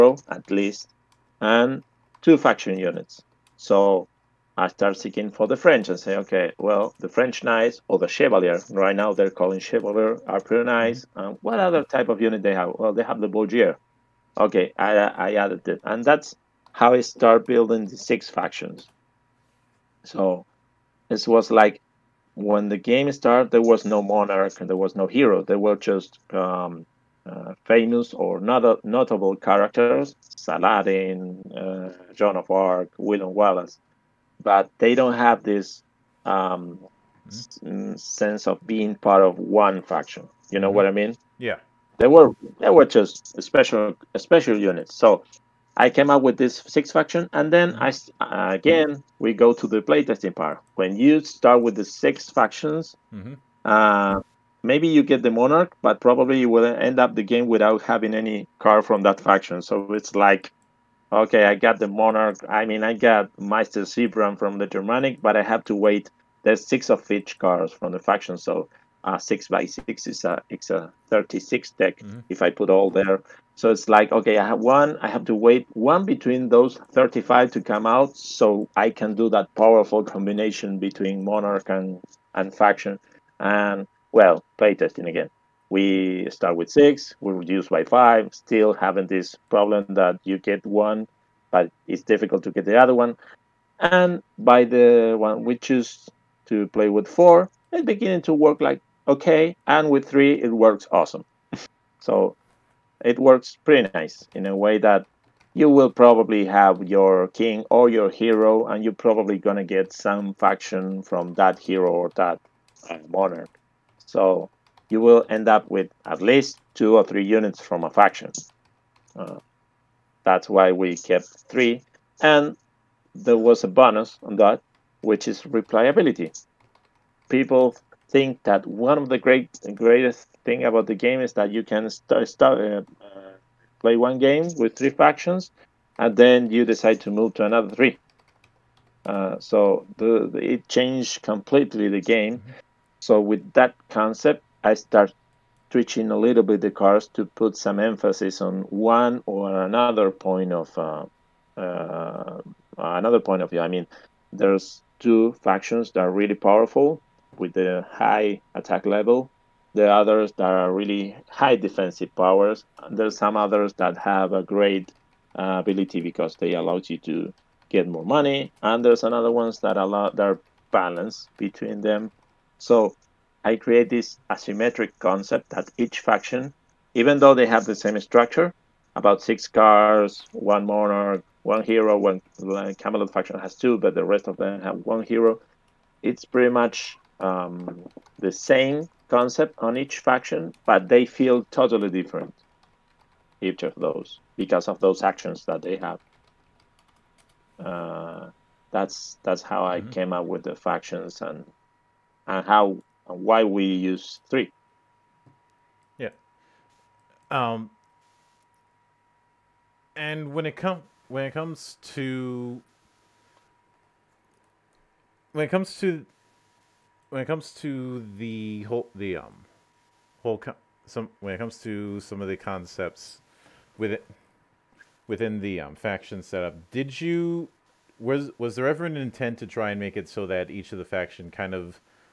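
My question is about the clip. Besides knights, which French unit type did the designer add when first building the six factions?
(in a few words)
Bourgeois.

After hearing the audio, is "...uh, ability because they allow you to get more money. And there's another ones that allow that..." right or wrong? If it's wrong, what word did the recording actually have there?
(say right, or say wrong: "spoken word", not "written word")
right.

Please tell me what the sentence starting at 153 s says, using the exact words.
I mean, there's two factions that are really powerful, with the high attack level.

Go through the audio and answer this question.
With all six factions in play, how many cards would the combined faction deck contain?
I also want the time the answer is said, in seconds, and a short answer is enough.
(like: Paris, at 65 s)
36, at 71 s.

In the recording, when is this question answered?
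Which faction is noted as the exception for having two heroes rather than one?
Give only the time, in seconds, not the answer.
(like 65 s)
182 s.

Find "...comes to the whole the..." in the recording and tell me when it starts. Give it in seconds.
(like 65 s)
217 s.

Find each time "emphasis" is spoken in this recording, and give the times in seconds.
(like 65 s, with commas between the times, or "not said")
147 s.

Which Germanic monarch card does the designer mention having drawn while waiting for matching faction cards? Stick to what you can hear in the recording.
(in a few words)
Meister Zebran.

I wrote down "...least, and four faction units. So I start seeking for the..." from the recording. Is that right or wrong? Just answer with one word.
wrong.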